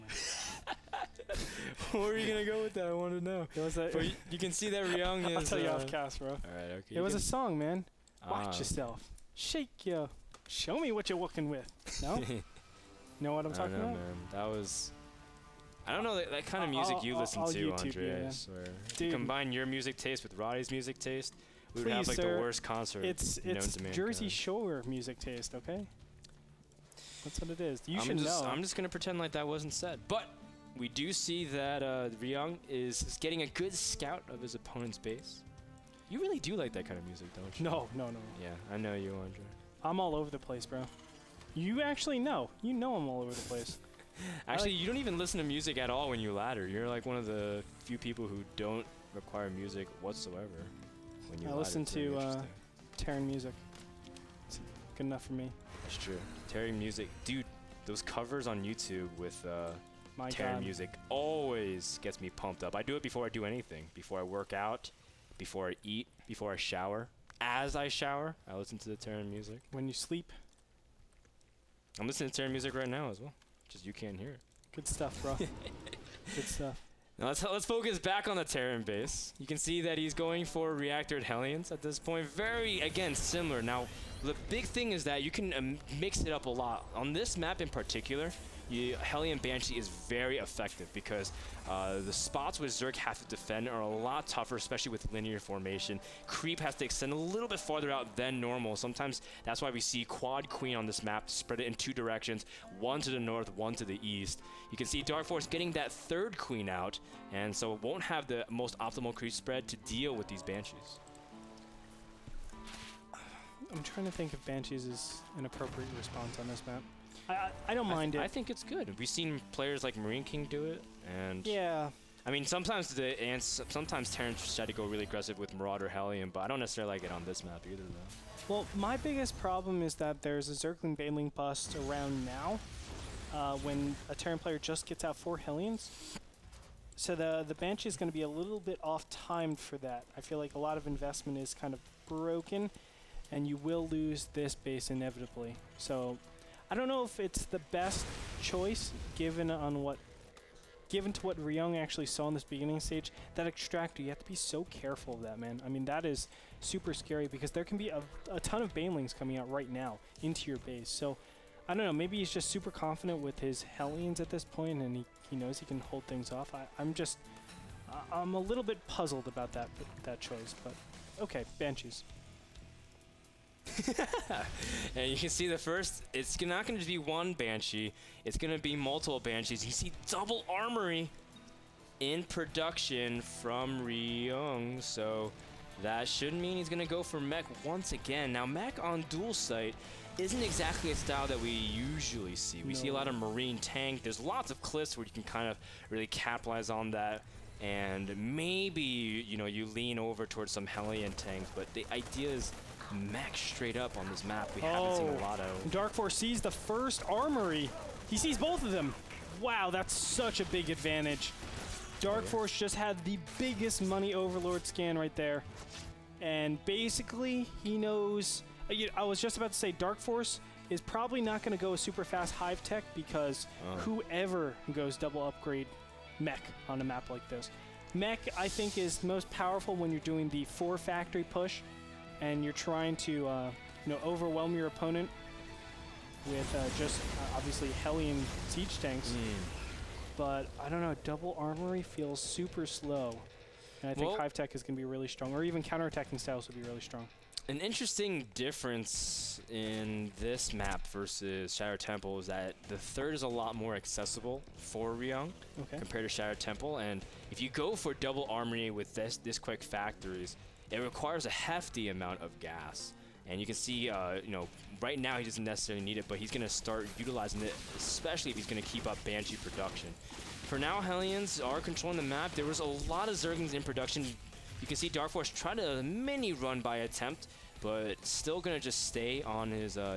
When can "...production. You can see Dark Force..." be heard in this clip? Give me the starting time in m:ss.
4:33.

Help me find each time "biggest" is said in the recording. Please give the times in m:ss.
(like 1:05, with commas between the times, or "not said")
2:08, 3:33.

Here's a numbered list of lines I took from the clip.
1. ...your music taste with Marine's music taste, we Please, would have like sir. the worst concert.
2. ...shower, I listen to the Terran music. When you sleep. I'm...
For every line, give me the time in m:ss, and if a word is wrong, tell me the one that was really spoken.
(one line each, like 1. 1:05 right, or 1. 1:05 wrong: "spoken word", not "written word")
1. 0:19 wrong: "Roddy", not "Marine"
2. 1:07 right.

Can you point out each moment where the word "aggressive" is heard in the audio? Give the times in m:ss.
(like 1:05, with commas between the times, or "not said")
2:05.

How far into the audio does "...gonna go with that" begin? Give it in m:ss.
0:02.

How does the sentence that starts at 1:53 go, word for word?
I'm trying to think if Banshees is an appropriate response on this map.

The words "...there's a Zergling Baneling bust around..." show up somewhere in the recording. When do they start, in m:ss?
2:10.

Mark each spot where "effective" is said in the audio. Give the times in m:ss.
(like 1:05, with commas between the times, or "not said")
1:30.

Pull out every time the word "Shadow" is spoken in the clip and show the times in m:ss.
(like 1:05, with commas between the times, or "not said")
4:11, 4:16.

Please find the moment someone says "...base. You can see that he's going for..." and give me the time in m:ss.
1:18.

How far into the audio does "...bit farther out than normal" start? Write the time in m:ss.
1:37.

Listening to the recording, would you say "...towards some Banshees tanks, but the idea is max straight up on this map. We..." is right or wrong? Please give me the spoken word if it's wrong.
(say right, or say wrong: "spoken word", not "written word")
wrong: "Hellion", not "Banshees".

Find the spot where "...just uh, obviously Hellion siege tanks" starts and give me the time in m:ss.
3:56.